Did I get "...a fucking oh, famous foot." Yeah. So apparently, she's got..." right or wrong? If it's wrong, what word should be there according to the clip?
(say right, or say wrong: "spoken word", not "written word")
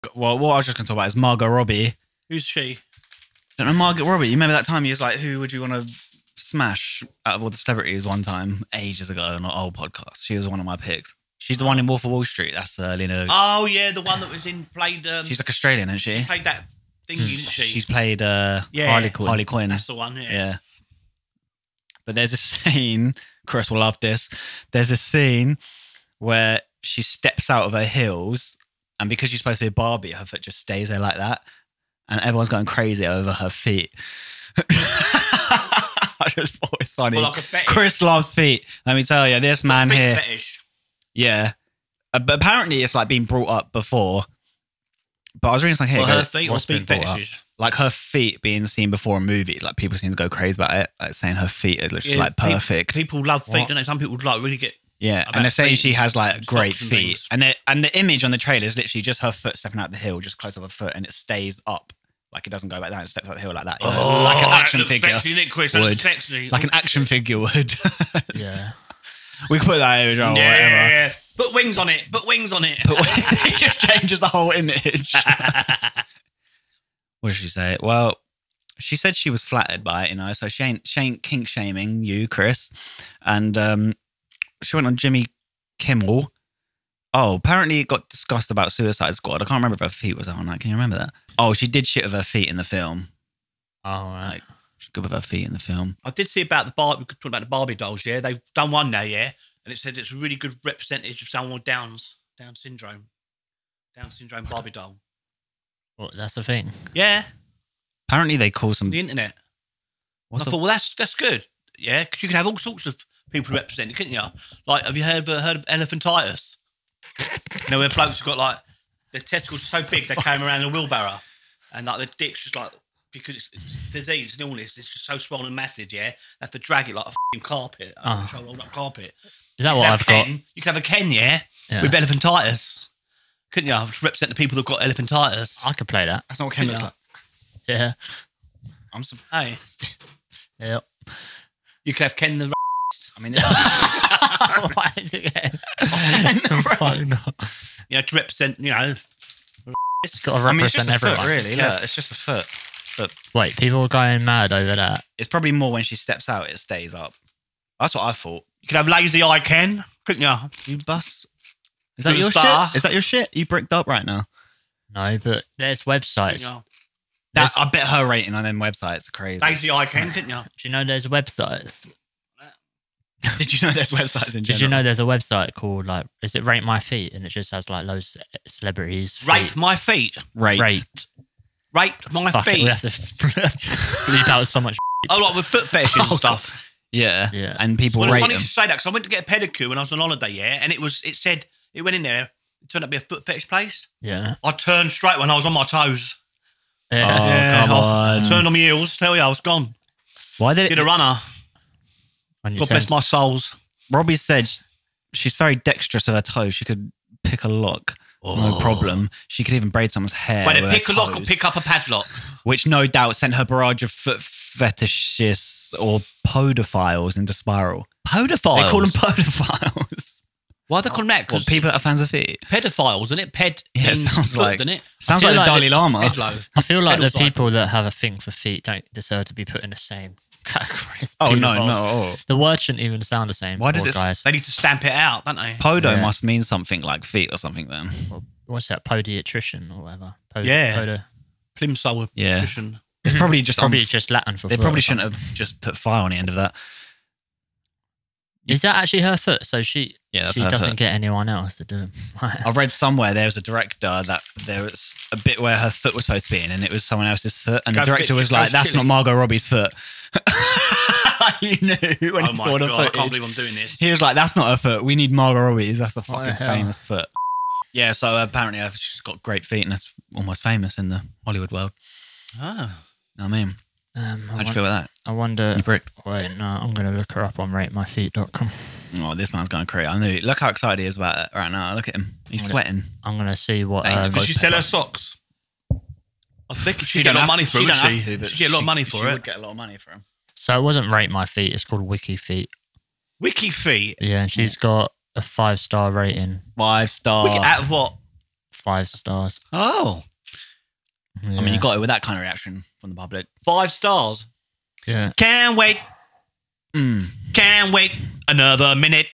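right.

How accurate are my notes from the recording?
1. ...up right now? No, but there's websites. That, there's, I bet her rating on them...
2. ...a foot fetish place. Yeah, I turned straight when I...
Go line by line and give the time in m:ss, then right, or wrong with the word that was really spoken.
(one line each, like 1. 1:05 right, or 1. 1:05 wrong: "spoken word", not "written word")
1. 2:43 right
2. 3:12 right.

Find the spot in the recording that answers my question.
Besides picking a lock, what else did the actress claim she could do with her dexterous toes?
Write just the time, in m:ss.
3:29.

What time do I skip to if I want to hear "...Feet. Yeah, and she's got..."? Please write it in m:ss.
4:53.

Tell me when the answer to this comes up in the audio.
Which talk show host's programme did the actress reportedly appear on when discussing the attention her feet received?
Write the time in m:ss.
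1:24.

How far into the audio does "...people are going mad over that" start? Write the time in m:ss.
2:33.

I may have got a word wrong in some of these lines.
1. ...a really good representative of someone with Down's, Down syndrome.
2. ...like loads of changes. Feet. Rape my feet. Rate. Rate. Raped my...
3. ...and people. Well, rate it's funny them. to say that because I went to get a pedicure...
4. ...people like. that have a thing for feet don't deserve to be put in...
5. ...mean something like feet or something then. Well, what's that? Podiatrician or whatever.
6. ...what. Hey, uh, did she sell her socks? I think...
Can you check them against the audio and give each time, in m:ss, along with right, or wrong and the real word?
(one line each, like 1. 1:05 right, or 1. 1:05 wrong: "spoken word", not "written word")
1. 1:40 right
2. 2:57 wrong: "celebrities", not "changes"
3. 3:07 right
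4. 3:47 right
5. 3:56 right
6. 4:43 right.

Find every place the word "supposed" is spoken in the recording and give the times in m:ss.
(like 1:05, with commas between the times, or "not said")
0:29, 4:16.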